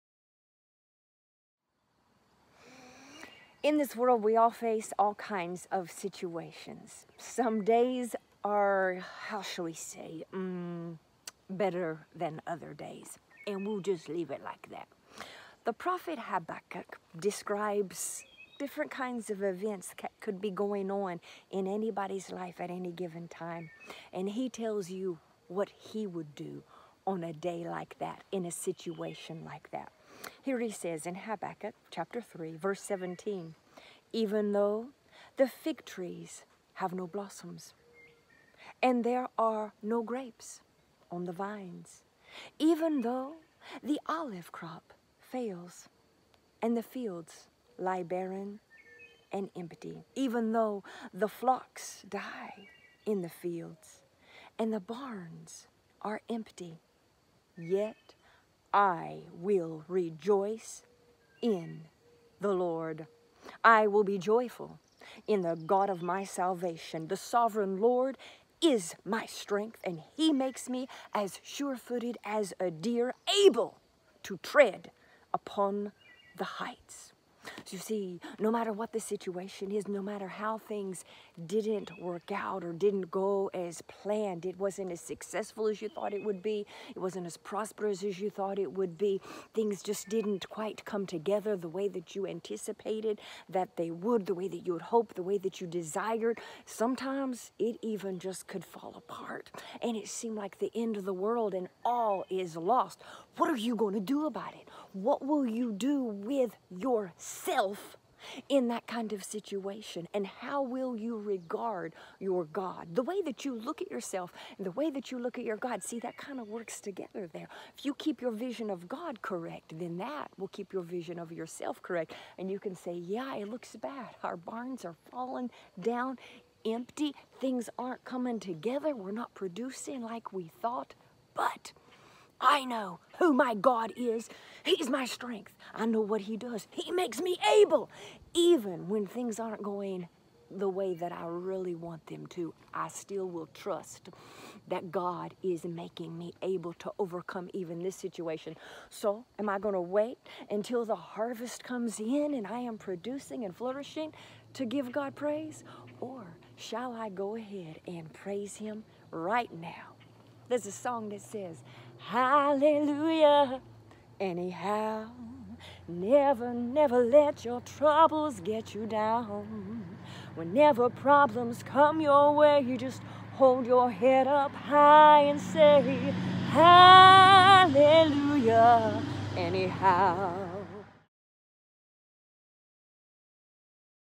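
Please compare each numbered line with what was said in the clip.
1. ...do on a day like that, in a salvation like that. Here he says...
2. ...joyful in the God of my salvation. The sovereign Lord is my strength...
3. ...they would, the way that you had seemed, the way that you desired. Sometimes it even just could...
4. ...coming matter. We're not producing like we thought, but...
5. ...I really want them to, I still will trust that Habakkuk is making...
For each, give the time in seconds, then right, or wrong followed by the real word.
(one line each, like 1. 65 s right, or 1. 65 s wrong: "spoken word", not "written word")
1. 26 s wrong: "situation", not "salvation"
2. 64 s right
3. 93 s wrong: "hoped", not "seemed"
4. 128 s wrong: "together", not "matter"
5. 141 s wrong: "God", not "Habakkuk".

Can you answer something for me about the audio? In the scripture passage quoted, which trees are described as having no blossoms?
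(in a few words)
Fig trees.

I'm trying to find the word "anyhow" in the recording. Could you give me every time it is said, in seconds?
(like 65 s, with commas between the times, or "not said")
164 s, 179 s.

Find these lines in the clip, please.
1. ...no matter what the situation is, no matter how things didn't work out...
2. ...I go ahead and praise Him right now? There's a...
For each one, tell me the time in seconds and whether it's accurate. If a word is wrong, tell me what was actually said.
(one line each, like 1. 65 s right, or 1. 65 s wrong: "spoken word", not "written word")
1. 78 s right
2. 156 s right.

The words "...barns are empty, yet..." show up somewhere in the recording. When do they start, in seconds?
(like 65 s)
54 s.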